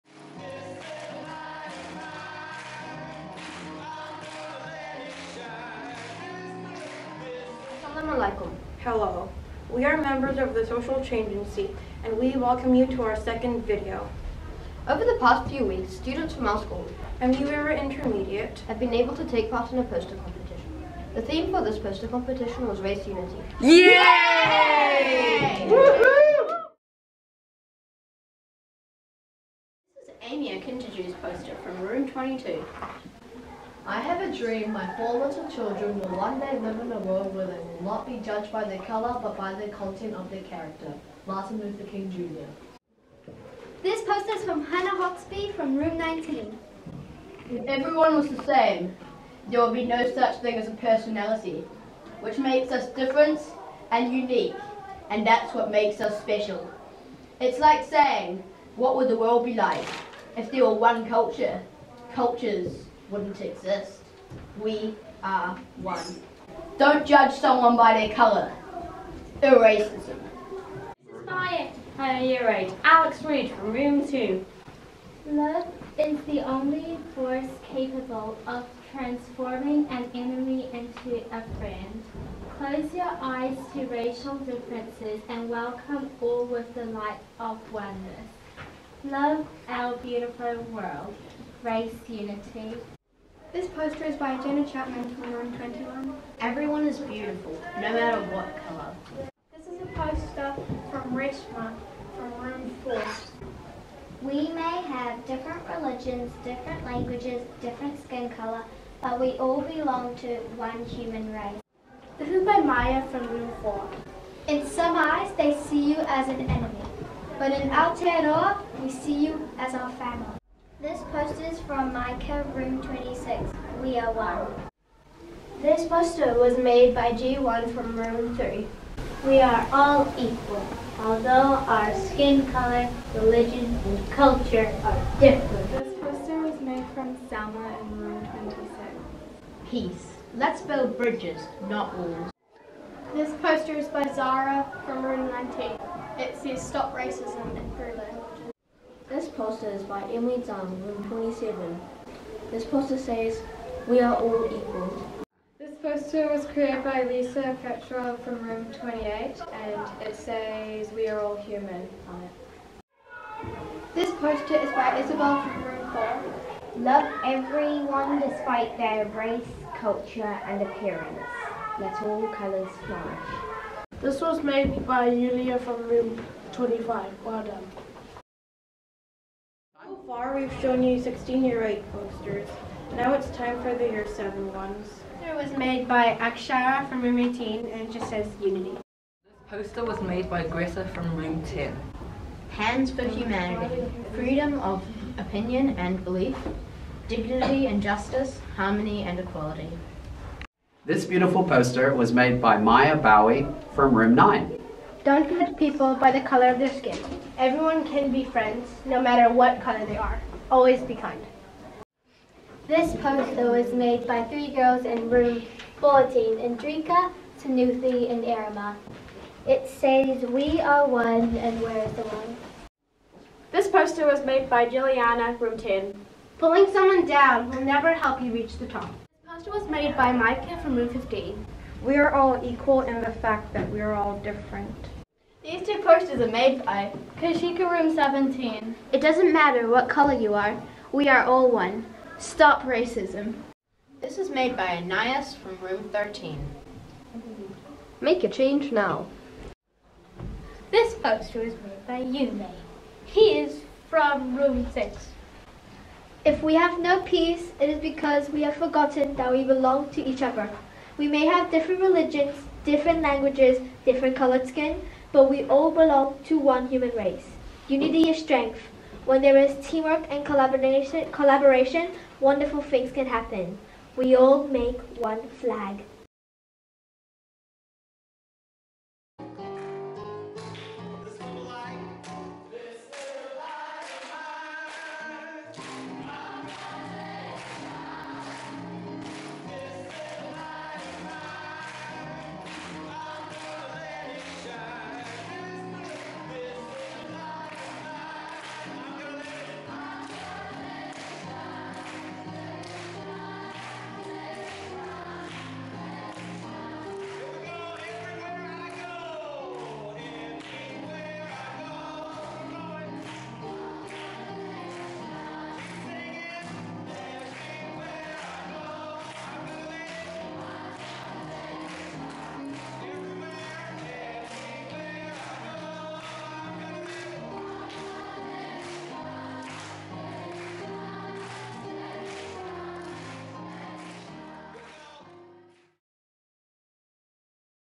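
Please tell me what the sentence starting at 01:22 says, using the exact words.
Close your eyes to racial differences and welcome all with the light of oneness.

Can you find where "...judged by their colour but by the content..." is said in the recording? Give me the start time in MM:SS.
00:38.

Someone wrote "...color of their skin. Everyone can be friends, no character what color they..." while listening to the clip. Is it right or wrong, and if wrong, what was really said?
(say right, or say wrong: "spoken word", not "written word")
wrong: "matter", not "character".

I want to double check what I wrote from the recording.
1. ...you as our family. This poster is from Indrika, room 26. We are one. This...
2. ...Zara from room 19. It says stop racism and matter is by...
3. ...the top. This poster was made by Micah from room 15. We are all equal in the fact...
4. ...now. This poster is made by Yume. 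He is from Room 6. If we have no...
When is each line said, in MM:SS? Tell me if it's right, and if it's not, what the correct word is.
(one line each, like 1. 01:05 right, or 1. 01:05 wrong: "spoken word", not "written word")
1. 01:59 wrong: "Micah", not "Indrika"
2. 02:24 wrong: "poster", not "matter"
3. 03:48 right
4. 04:08 right.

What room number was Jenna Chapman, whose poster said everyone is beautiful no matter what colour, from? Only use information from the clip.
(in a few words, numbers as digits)
21.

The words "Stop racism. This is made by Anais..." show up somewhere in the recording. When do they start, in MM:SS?
04:02.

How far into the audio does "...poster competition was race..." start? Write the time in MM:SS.
00:21.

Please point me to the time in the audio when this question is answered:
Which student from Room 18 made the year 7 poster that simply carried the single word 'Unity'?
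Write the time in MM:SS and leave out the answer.
03:06.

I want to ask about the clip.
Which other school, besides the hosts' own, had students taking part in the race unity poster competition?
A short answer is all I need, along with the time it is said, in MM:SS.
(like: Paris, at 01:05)
Remuera Intermediate, at 00:17.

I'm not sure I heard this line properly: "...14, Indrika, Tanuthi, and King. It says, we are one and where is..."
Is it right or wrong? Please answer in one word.
wrong.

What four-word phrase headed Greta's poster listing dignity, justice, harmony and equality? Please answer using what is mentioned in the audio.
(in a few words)
Hands for Humanity.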